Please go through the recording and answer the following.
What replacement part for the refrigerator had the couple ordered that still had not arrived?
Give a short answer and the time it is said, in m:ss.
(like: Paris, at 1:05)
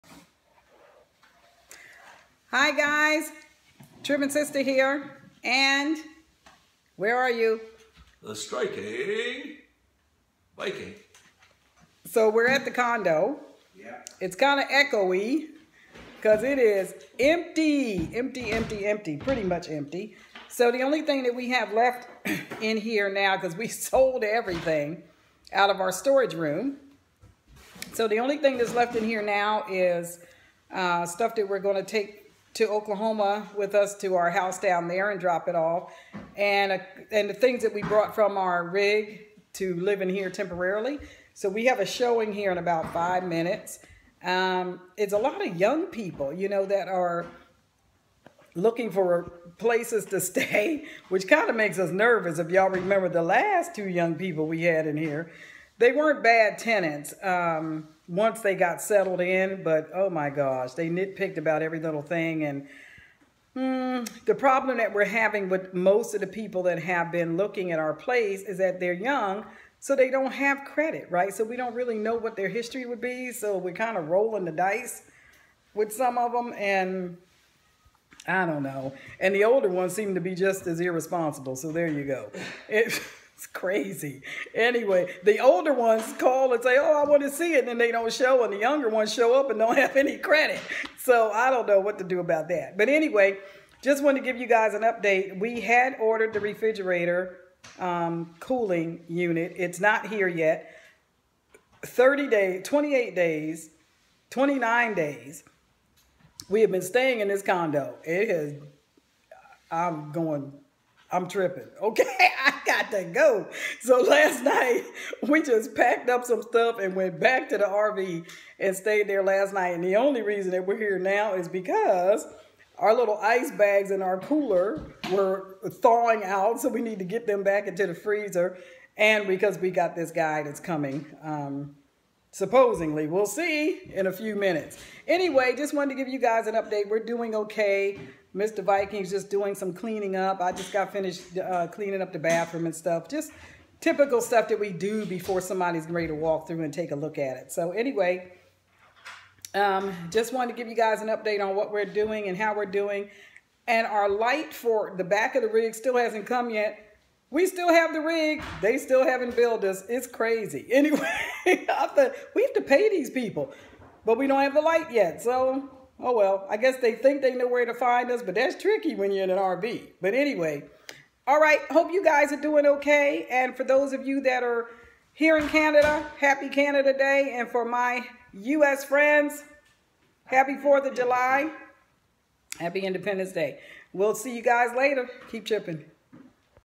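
cooling unit, at 1:38.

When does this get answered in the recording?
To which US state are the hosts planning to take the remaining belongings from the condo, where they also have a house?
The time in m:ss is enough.
0:32.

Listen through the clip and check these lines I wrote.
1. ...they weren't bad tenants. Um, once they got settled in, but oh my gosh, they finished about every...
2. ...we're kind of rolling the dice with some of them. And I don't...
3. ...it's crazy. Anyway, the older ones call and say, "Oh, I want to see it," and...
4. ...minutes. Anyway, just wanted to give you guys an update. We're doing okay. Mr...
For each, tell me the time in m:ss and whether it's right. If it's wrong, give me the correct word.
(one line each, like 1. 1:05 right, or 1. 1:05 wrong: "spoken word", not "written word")
1. 0:55 wrong: "nitpicked", not "finished"
2. 1:13 right
3. 1:23 right
4. 2:14 right.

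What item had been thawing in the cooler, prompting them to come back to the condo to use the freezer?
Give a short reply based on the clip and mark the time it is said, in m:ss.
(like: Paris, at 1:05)
ice bags, at 2:03.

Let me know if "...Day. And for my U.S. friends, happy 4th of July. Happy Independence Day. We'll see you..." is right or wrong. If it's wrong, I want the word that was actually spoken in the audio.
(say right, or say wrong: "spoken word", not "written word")
right.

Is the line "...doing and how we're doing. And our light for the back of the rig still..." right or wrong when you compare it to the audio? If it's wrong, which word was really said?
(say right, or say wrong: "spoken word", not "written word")
right.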